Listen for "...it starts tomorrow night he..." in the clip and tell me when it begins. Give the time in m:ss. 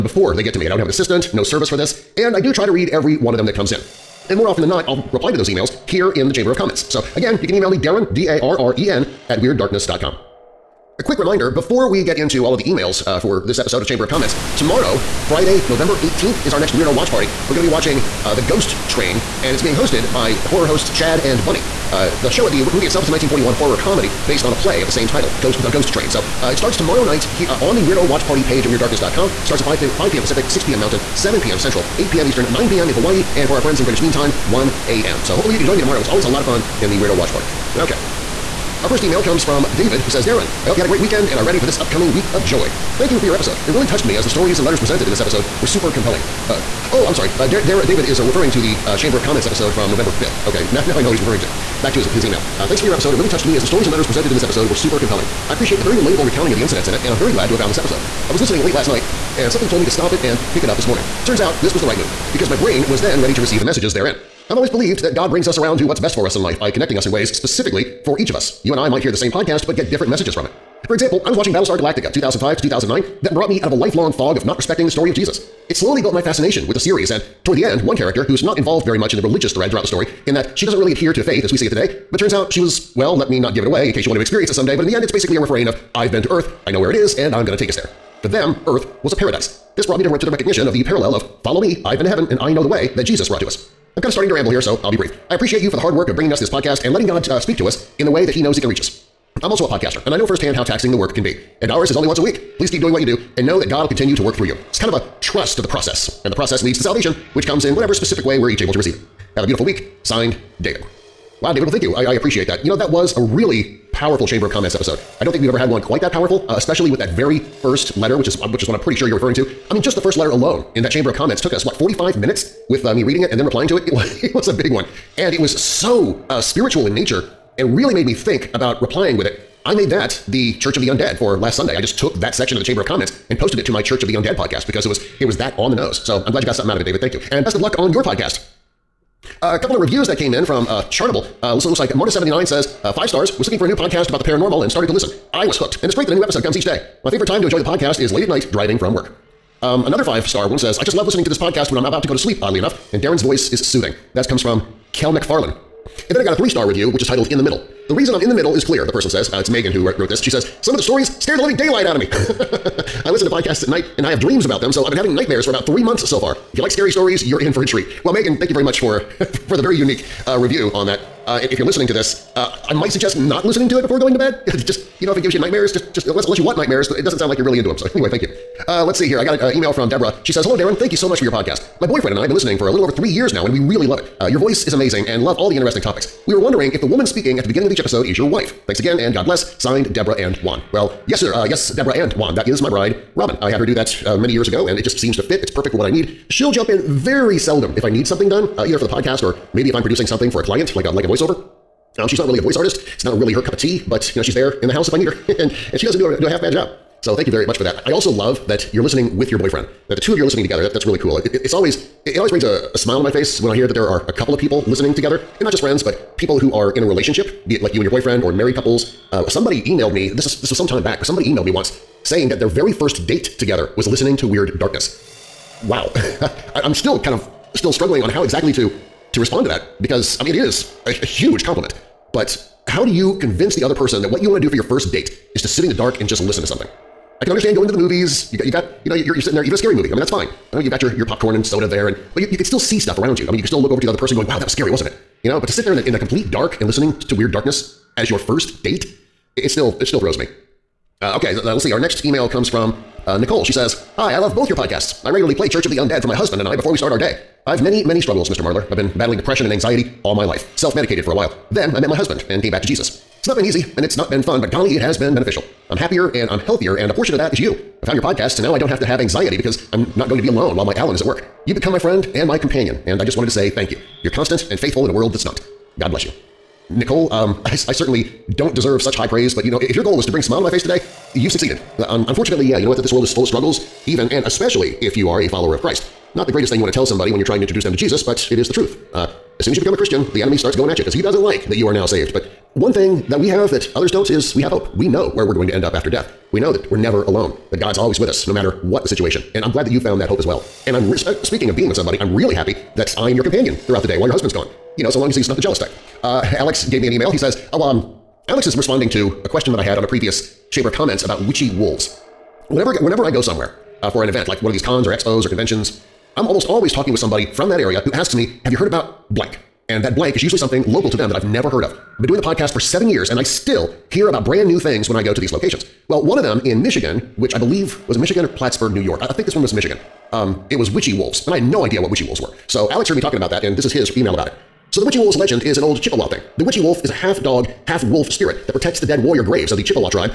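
0:26.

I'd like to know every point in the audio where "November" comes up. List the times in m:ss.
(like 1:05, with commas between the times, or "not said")
0:15, 0:49.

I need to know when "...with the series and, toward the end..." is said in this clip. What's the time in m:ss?
1:16.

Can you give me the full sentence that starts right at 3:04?
Uh, your voice is amazing and love all the interesting topics.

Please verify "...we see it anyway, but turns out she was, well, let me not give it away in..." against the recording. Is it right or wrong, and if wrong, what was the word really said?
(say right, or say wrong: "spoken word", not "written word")
wrong: "today", not "anyway".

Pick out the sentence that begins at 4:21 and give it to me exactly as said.
Then I met my husband and came back to Jesus.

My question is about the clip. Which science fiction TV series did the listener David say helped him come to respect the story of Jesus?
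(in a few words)
Battlestar Galactica.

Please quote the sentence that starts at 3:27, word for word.
So thank you very much for that.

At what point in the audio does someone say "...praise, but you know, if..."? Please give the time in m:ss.
4:39.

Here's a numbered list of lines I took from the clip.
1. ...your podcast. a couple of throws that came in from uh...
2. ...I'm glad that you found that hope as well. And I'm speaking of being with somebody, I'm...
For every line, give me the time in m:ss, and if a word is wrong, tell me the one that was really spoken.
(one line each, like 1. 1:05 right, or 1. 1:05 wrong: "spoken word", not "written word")
1. 2:17 wrong: "reviews", not "throws"
2. 4:59 right.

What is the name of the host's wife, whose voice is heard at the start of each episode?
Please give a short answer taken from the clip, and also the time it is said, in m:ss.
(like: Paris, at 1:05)
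Robin, at 3:13.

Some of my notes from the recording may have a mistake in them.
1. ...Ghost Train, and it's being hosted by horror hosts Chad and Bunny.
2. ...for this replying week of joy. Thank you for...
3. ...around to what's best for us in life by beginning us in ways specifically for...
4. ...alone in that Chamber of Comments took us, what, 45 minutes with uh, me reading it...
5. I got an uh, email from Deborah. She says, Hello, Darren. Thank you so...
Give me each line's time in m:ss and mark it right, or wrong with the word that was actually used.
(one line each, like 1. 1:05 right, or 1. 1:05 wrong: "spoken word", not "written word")
1. 0:18 right
2. 0:41 wrong: "upcoming", not "replying"
3. 1:05 wrong: "connecting", not "beginning"
4. 2:00 right
5. 2:59 right.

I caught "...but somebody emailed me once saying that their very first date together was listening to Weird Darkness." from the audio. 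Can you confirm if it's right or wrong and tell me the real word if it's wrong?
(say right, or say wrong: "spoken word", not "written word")
right.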